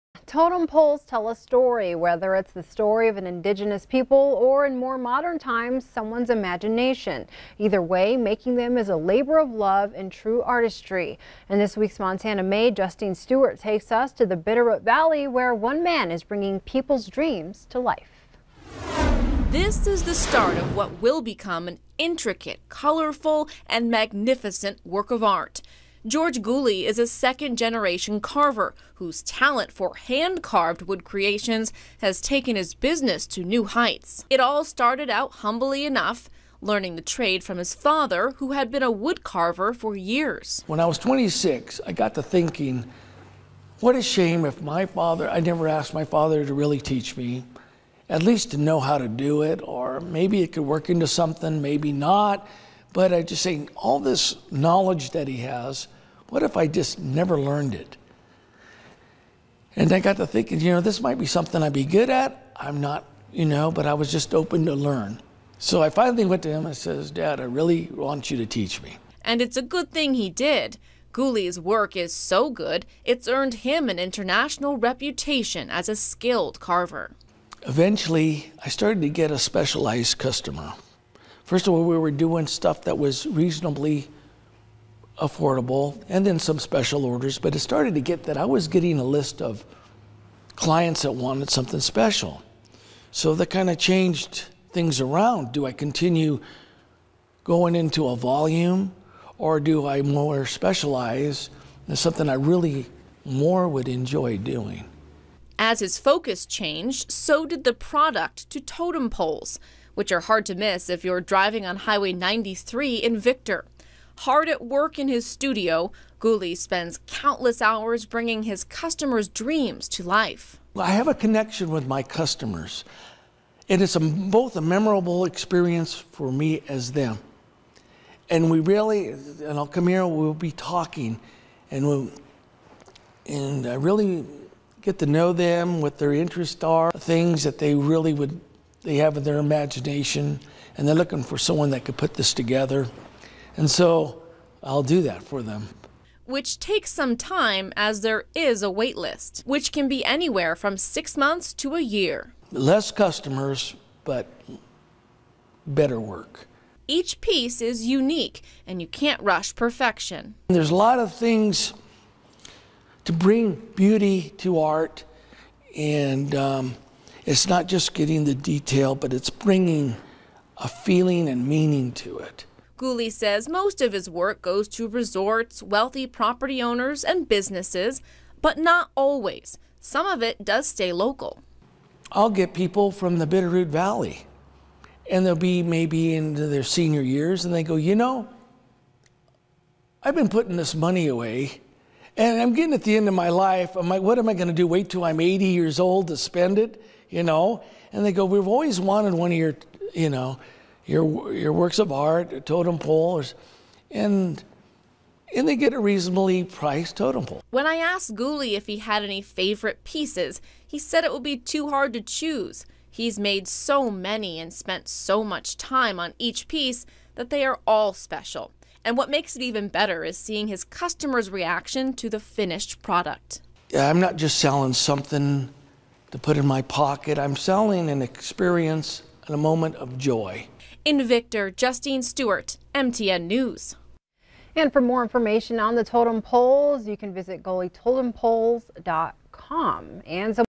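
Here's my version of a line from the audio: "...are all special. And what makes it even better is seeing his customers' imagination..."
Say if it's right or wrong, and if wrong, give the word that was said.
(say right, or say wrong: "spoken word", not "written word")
wrong: "reaction", not "imagination".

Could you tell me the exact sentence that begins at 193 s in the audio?
I'm like, What am I going to do?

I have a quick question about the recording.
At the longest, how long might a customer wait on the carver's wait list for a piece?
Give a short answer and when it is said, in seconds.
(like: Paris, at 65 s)
a year, at 151 s.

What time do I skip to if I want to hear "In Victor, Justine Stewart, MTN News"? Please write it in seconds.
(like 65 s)
230 s.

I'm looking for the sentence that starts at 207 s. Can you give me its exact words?
When I asked Gulli if he had any favorite pieces, he said it would be too hard to choose.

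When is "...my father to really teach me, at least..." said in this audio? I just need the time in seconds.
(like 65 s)
45 s.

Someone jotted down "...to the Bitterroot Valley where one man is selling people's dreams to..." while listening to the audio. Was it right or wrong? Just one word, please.
wrong.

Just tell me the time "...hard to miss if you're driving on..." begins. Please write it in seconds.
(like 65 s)
110 s.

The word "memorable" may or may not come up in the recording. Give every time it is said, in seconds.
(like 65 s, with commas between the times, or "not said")
124 s.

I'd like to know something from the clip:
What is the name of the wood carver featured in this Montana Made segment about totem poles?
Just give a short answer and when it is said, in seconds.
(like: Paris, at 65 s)
George Gulli, at 26 s.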